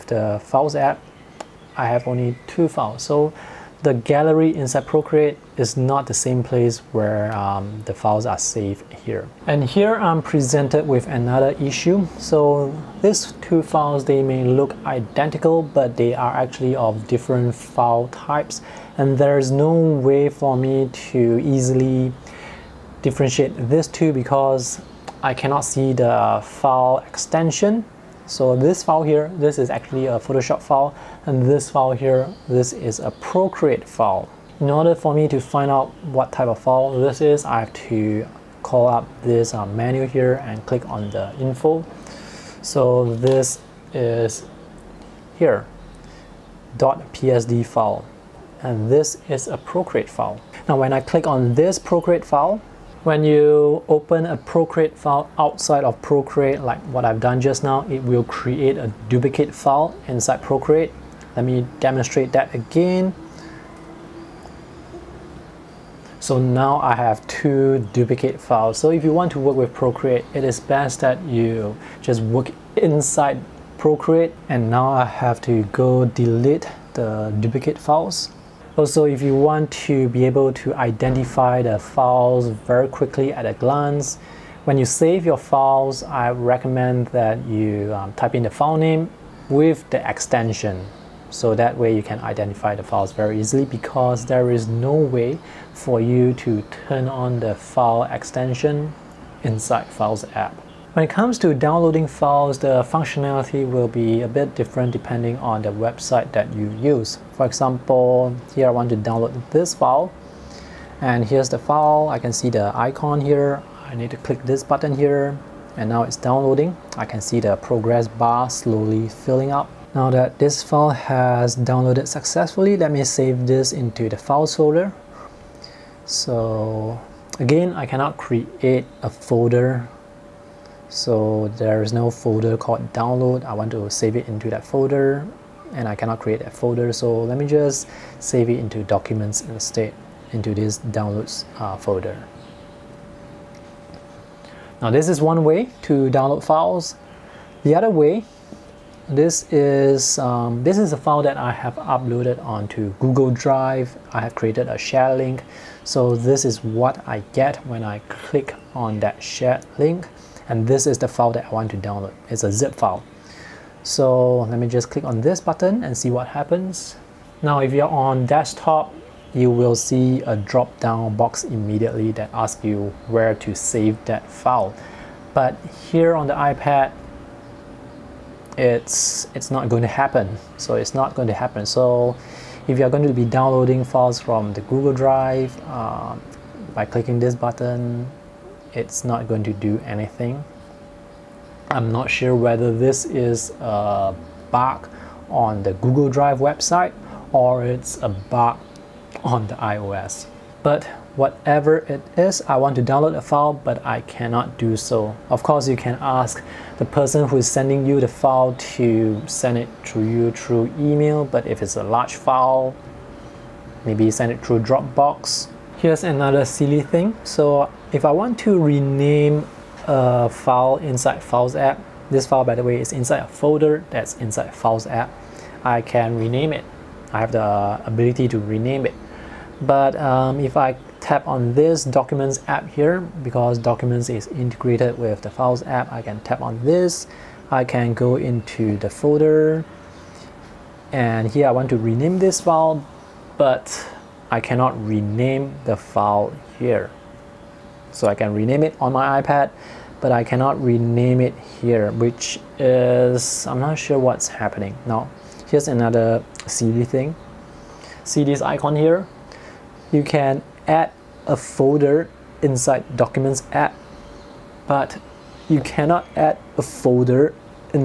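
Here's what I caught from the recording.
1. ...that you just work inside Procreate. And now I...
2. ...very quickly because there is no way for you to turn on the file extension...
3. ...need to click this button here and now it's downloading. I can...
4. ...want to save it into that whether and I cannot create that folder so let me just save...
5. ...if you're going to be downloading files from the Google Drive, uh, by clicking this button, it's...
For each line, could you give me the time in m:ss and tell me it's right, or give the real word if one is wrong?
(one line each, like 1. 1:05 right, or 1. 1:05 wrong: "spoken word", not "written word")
1. 1:10 right
2. 1:33 wrong: "easily", not "quickly"
3. 1:53 right
4. 2:13 wrong: "folder", not "whether"
5. 3:02 right.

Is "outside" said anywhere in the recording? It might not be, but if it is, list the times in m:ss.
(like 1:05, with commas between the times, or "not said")
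0:55.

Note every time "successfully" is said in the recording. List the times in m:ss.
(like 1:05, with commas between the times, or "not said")
2:02.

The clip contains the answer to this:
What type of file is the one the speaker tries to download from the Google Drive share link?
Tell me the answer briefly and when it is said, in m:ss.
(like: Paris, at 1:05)
Zip file, at 2:42.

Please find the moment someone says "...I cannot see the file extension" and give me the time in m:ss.
0:25.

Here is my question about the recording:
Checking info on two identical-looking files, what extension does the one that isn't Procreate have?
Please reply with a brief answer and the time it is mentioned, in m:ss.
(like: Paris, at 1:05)
.psd, at 0:46.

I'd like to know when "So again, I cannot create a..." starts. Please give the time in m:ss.
2:06.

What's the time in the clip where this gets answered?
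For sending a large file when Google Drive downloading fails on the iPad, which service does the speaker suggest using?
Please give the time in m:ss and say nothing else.
3:34.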